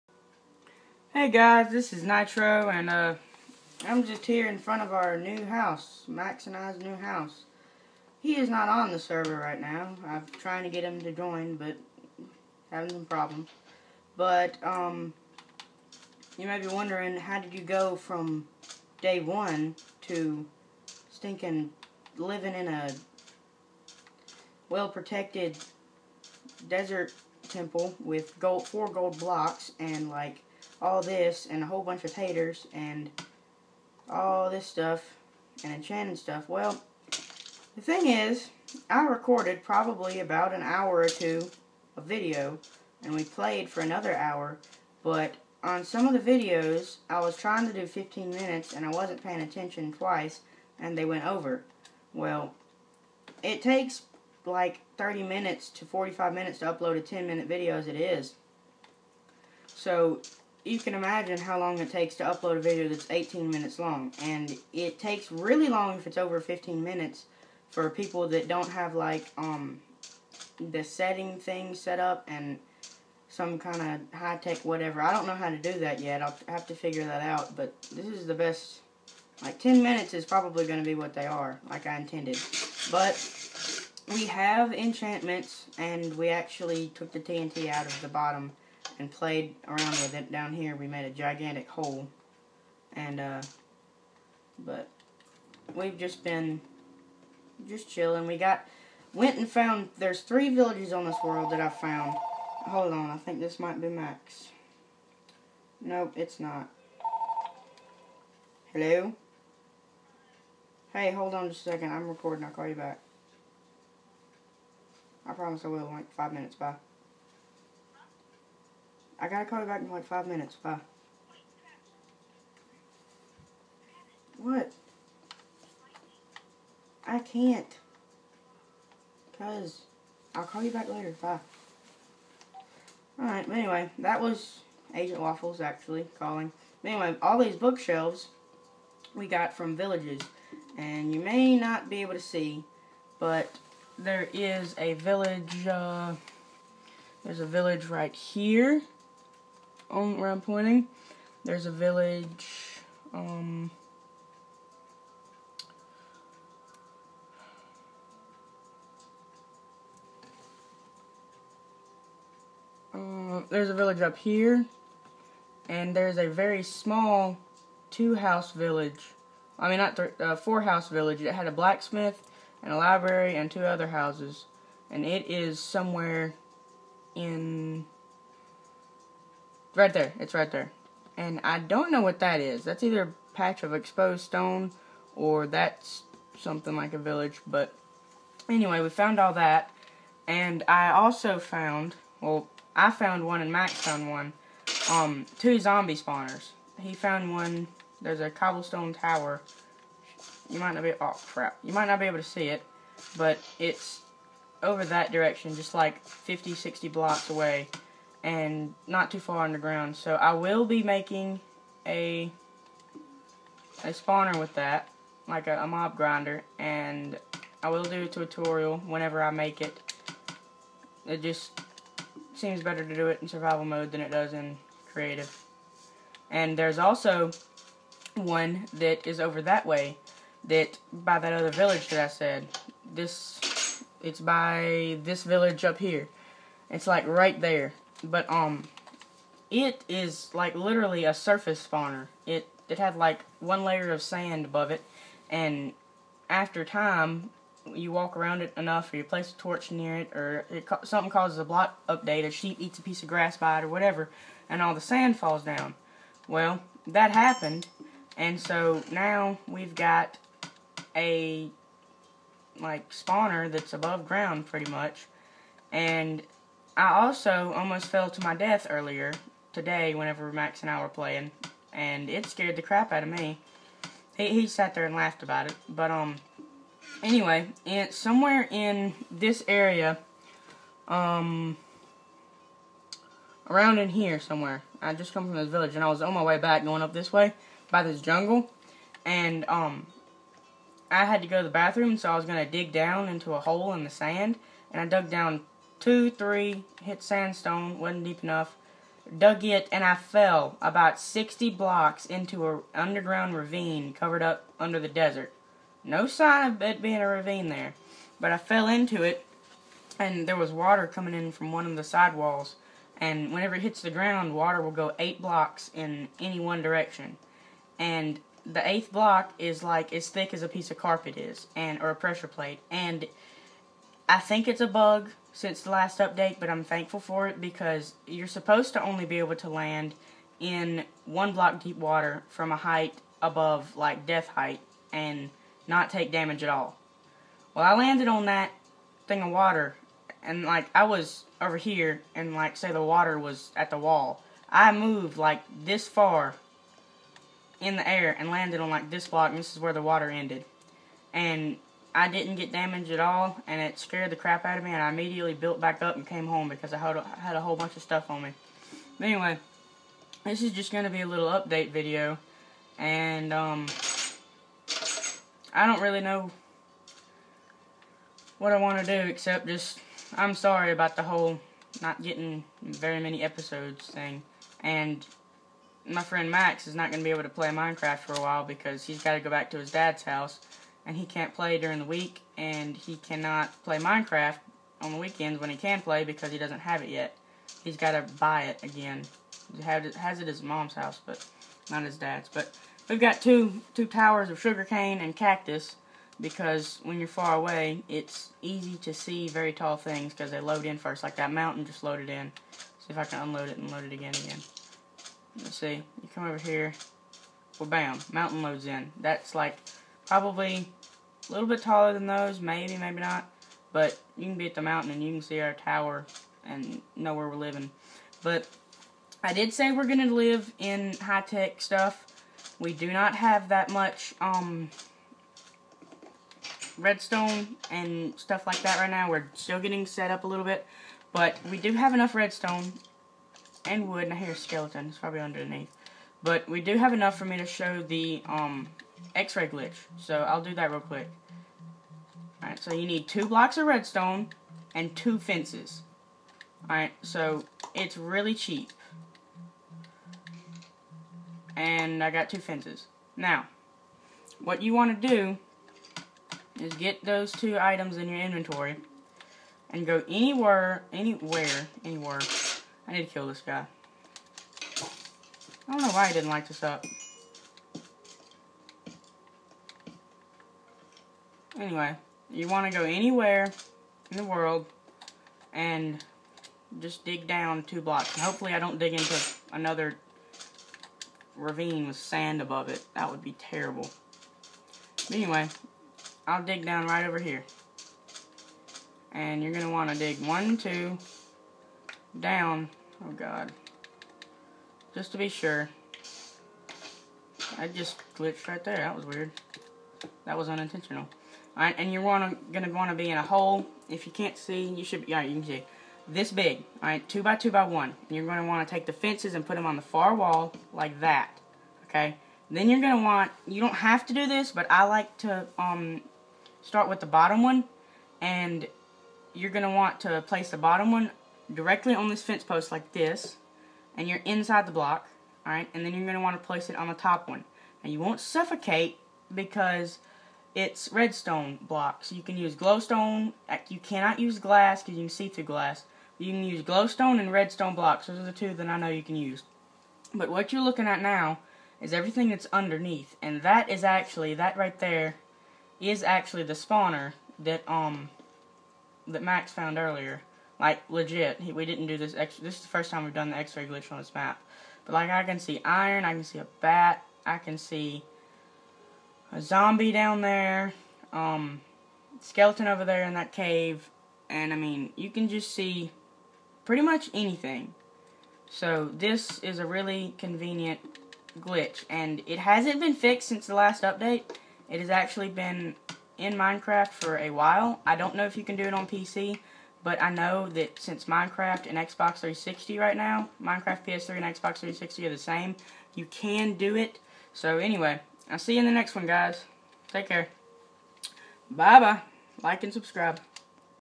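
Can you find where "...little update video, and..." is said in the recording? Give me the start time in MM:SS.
06:01.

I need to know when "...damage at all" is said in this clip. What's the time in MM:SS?
05:36.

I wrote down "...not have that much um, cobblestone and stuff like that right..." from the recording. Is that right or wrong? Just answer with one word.
wrong.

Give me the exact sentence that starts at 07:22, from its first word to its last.
Alright, so you need two blocks of redstone and two fences.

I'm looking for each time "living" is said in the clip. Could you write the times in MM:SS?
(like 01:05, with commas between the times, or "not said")
00:22, 06:57.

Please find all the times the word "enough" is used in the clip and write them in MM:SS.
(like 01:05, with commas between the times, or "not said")
04:08, 04:58, 07:11, 07:16.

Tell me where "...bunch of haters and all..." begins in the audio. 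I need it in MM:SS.
00:31.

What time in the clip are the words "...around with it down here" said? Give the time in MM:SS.
01:29.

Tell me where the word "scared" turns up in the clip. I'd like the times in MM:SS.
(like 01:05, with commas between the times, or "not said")
04:32, 05:53.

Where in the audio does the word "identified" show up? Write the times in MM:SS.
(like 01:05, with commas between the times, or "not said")
not said.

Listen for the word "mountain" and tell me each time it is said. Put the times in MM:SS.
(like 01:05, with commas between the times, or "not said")
06:41, 06:48, 06:54.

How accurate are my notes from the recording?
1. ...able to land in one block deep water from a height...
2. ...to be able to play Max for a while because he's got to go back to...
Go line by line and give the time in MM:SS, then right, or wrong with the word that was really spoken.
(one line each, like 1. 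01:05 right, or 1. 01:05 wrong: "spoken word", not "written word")
1. 05:29 right
2. 06:17 wrong: "Minecraft", not "Max".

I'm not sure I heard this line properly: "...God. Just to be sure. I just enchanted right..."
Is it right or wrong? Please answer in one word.
wrong.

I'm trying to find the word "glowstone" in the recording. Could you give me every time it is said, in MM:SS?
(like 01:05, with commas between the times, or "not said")
08:52, 08:56.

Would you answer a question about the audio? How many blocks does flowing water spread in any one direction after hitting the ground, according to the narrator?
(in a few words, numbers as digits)
8.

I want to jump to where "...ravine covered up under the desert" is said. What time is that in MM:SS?
05:03.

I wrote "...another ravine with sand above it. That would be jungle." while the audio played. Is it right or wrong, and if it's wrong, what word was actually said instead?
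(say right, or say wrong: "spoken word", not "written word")
wrong: "terrible", not "jungle".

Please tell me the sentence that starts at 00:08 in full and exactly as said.
He is not on the server right now.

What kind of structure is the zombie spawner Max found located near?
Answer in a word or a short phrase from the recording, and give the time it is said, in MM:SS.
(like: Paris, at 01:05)
cobblestone tower, at 03:18.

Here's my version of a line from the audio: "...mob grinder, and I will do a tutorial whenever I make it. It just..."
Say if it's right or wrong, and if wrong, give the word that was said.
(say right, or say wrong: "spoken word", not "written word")
right.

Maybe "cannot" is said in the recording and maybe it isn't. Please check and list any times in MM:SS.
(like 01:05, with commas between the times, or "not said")
06:22, 08:53.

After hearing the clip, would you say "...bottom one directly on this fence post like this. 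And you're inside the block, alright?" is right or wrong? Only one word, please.
right.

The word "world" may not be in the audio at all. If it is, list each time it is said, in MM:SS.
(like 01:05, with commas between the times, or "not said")
01:41, 07:54.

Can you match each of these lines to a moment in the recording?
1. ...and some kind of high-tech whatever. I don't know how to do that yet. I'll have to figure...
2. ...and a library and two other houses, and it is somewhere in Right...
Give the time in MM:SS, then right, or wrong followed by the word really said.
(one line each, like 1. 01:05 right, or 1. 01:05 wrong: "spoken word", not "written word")
1. 01:12 right
2. 02:52 right.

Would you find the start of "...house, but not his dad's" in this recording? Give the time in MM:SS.
06:30.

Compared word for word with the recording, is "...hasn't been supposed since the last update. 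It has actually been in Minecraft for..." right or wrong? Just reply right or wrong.
wrong.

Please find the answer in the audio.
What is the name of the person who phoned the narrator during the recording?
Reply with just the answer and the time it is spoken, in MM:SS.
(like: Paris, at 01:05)
Agent Waffles, at 02:14.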